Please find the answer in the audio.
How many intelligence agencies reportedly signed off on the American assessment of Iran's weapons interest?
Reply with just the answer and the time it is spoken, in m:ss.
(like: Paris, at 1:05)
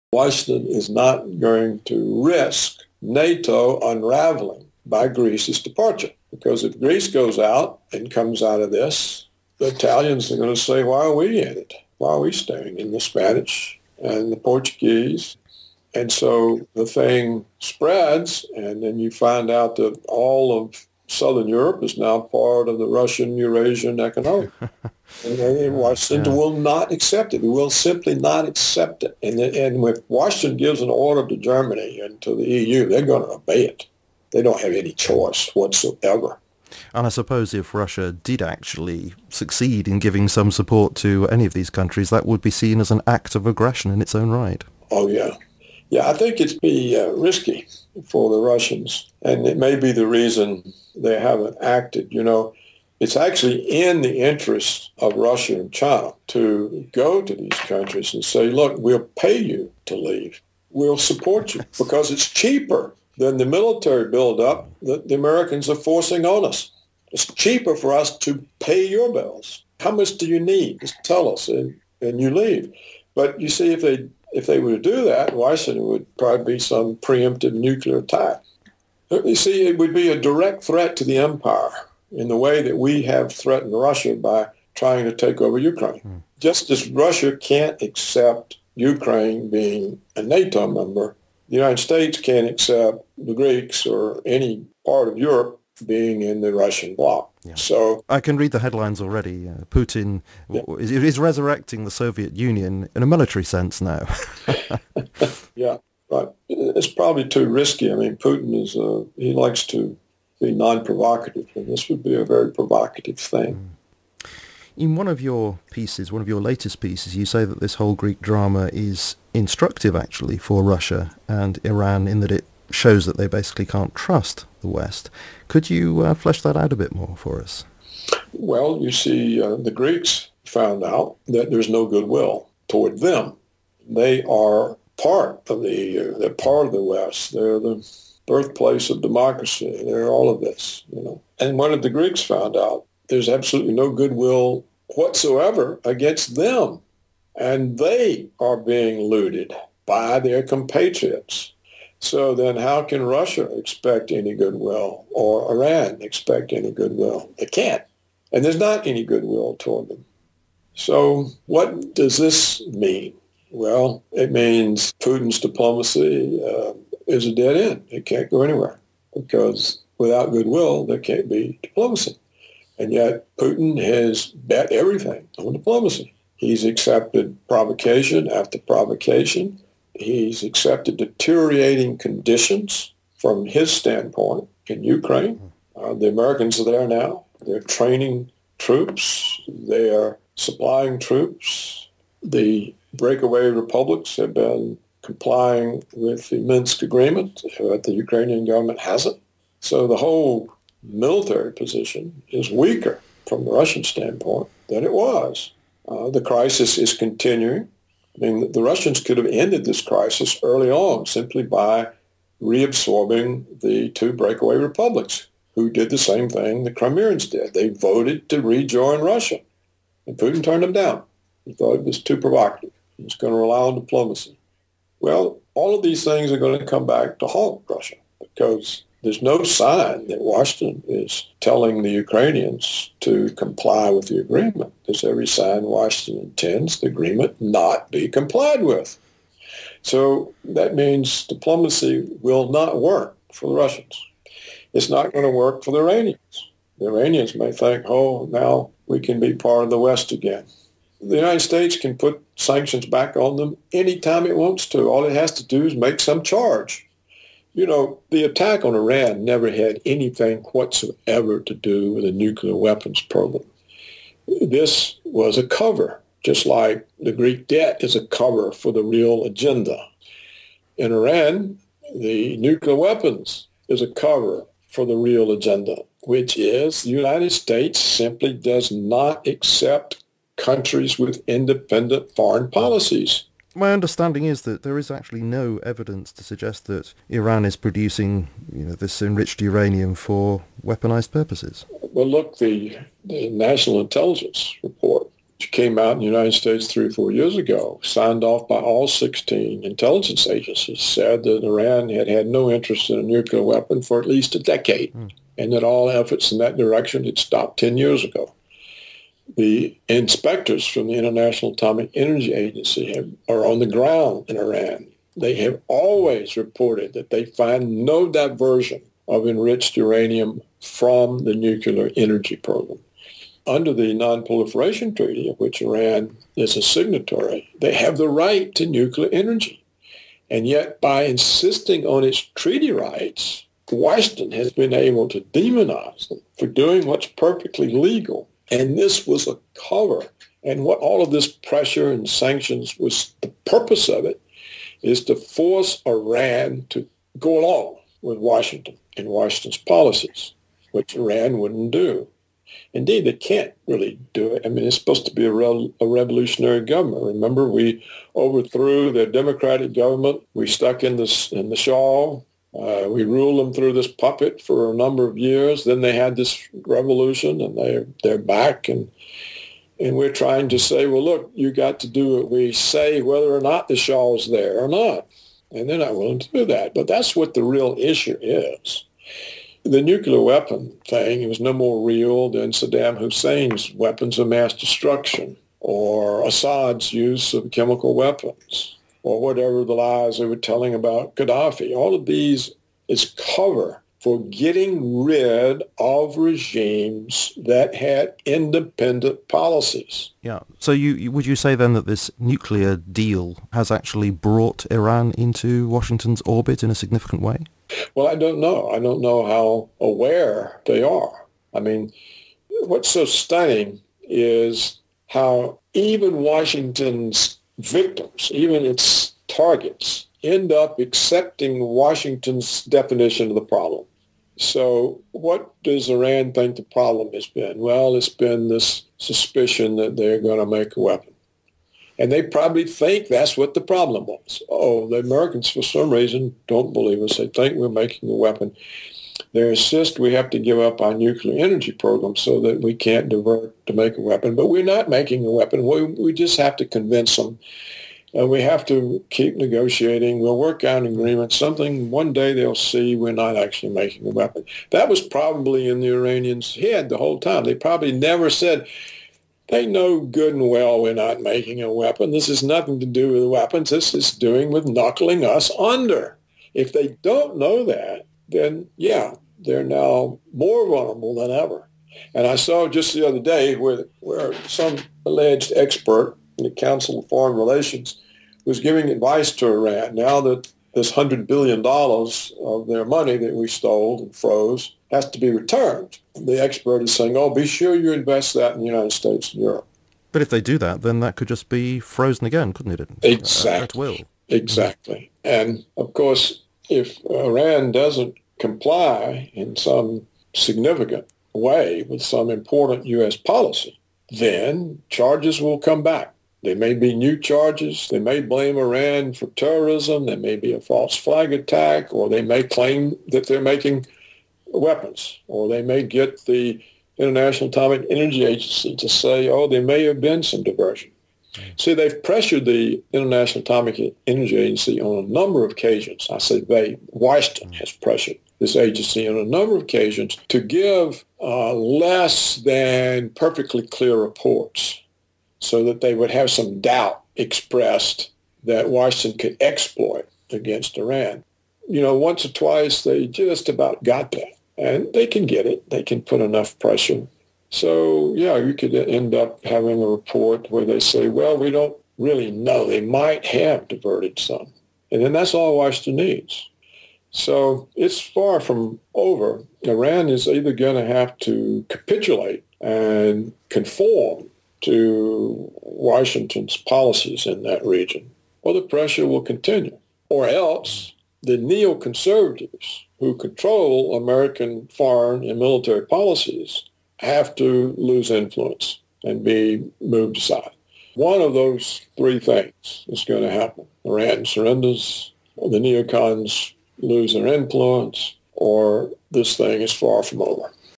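16, at 4:58.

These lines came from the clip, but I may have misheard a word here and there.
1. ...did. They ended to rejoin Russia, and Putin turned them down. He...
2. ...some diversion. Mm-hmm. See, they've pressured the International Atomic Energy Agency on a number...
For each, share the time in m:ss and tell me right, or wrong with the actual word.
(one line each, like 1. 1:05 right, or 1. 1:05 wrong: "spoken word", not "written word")
1. 3:37 wrong: "voted", not "ended"
2. 8:40 right.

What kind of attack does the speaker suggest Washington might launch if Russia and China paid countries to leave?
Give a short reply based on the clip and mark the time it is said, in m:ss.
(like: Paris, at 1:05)
preemptive nuclear attack, at 1:16.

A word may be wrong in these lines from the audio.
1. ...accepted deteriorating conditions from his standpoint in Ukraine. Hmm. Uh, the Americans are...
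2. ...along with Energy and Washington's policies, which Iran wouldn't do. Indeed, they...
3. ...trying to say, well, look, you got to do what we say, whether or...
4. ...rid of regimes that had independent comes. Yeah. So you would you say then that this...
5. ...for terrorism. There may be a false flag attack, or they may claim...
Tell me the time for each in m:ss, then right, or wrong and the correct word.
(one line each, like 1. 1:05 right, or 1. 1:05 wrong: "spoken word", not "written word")
1. 3:00 right
2. 5:47 wrong: "Washington", not "Energy"
3. 6:10 right
4. 6:35 wrong: "policies", not "comes"
5. 8:29 right.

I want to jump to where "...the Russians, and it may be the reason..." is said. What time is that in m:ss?
0:48.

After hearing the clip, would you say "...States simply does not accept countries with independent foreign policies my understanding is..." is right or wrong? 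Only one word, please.
right.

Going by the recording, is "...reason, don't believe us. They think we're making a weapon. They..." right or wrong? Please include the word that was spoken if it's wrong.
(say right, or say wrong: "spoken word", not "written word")
right.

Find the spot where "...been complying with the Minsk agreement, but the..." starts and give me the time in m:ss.
3:14.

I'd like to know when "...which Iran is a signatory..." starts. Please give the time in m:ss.
5:25.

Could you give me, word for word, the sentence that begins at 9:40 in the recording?
One of those three things is going to happen.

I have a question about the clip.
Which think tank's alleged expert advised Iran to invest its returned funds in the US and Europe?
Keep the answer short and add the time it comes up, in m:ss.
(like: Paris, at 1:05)
Council of Foreign Relations, at 7:56.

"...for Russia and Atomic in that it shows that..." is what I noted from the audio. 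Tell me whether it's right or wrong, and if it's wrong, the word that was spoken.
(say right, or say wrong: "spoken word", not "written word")
wrong: "Iran", not "Atomic".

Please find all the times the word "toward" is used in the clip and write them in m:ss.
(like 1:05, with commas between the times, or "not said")
2:12, 2:39.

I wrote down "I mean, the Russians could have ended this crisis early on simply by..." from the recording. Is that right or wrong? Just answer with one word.
right.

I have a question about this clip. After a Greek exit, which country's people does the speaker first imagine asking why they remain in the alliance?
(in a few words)
Italians.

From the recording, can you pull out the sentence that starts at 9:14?
And then that's all Washington needs.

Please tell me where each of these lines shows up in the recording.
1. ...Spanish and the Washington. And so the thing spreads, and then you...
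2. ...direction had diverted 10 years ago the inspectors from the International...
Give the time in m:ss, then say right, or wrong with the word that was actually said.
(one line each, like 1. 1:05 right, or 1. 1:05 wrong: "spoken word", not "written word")
1. 0:12 wrong: "Portuguese", not "Washington"
2. 5:06 wrong: "stopped", not "diverted".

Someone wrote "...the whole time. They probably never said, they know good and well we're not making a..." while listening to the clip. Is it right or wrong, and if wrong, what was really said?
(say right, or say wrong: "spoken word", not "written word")
right.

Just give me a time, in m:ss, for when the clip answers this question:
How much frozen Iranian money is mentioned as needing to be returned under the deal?
8:00.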